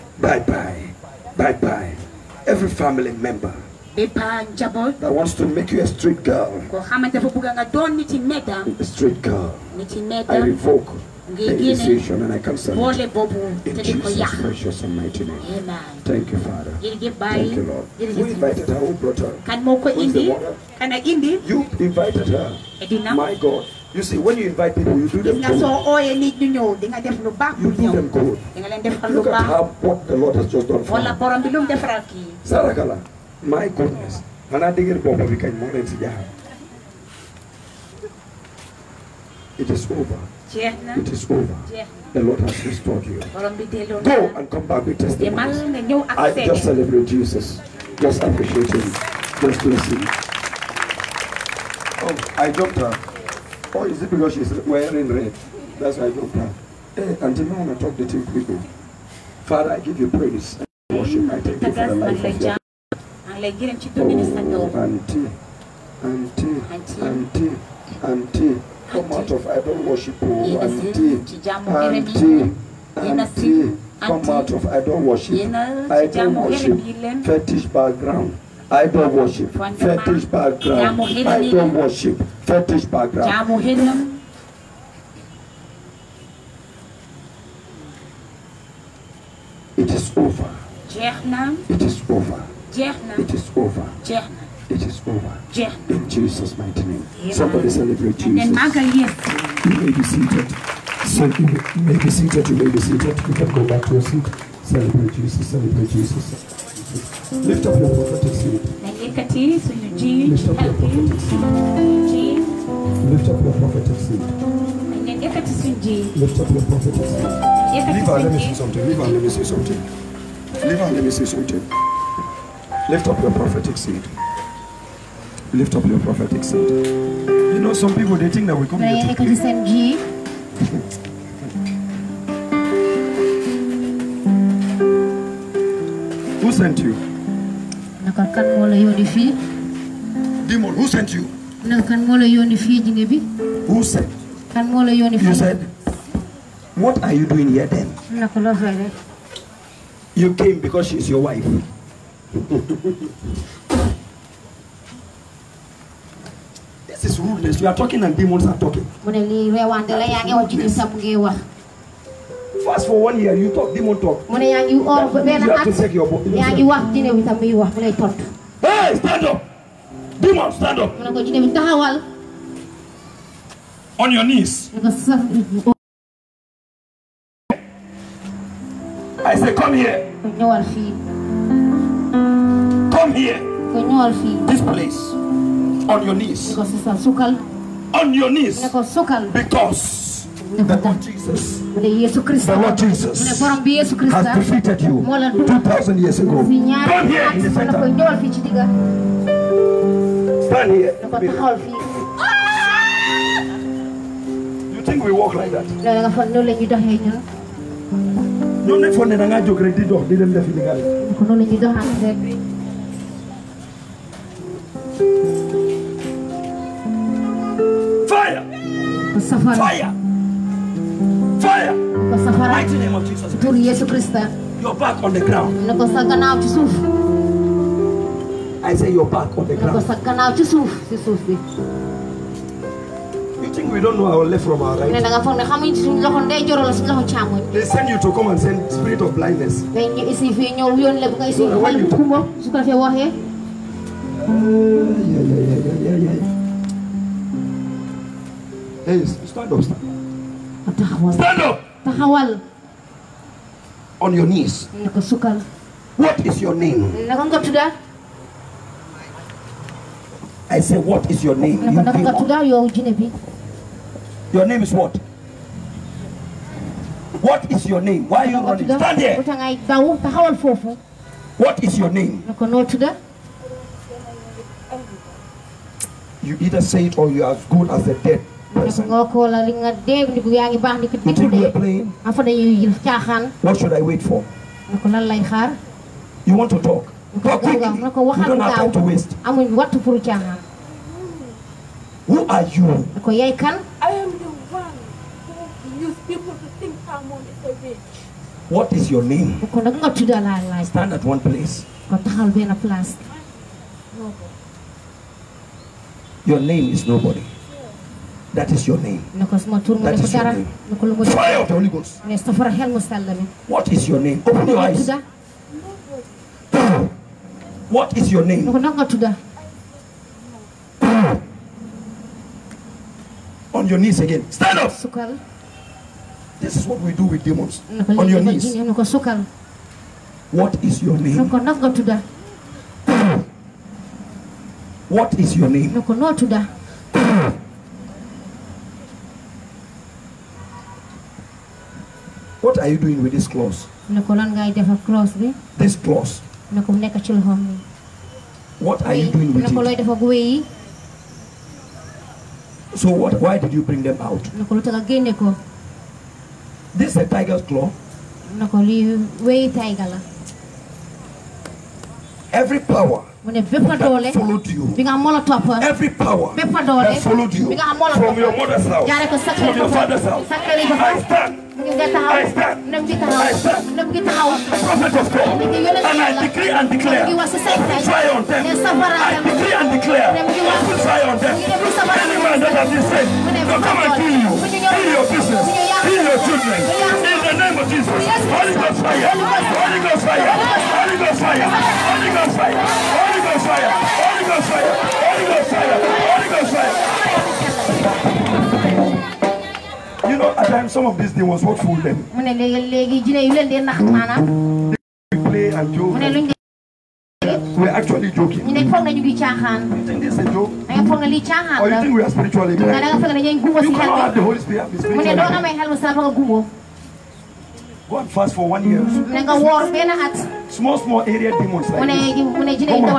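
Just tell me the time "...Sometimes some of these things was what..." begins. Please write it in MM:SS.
06:40.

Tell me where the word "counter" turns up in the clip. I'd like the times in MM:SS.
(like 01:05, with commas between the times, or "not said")
not said.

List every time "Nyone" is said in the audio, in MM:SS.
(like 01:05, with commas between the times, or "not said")
03:28.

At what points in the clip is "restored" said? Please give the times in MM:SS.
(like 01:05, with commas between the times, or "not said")
00:42.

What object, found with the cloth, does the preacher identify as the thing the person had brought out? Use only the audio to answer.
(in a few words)
tiger's claw.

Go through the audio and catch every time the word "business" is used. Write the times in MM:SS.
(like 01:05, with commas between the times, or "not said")
06:25.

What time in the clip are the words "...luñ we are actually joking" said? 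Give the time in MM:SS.
06:46.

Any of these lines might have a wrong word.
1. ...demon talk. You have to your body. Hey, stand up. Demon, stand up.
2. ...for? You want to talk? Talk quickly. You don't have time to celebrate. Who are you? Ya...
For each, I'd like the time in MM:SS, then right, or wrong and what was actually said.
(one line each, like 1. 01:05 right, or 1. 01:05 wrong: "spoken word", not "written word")
1. 02:43 right
2. 04:44 wrong: "waste", not "celebrate".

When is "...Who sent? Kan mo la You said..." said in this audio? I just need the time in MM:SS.
02:23.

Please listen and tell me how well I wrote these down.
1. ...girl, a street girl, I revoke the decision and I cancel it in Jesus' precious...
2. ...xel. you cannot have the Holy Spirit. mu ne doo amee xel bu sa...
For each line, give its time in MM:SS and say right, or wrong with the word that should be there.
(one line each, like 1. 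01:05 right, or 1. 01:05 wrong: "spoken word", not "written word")
1. 00:06 right
2. 06:53 right.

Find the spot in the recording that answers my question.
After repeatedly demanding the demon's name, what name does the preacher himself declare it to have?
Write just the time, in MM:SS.
05:06.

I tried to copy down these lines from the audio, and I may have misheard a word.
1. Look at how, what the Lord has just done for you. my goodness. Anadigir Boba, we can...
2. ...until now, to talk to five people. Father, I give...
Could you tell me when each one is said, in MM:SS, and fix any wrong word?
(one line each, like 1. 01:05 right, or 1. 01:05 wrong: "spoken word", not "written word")
1. 00:29 right
2. 00:57 wrong: "two", not "five".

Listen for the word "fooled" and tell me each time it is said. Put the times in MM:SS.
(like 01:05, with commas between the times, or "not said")
06:41.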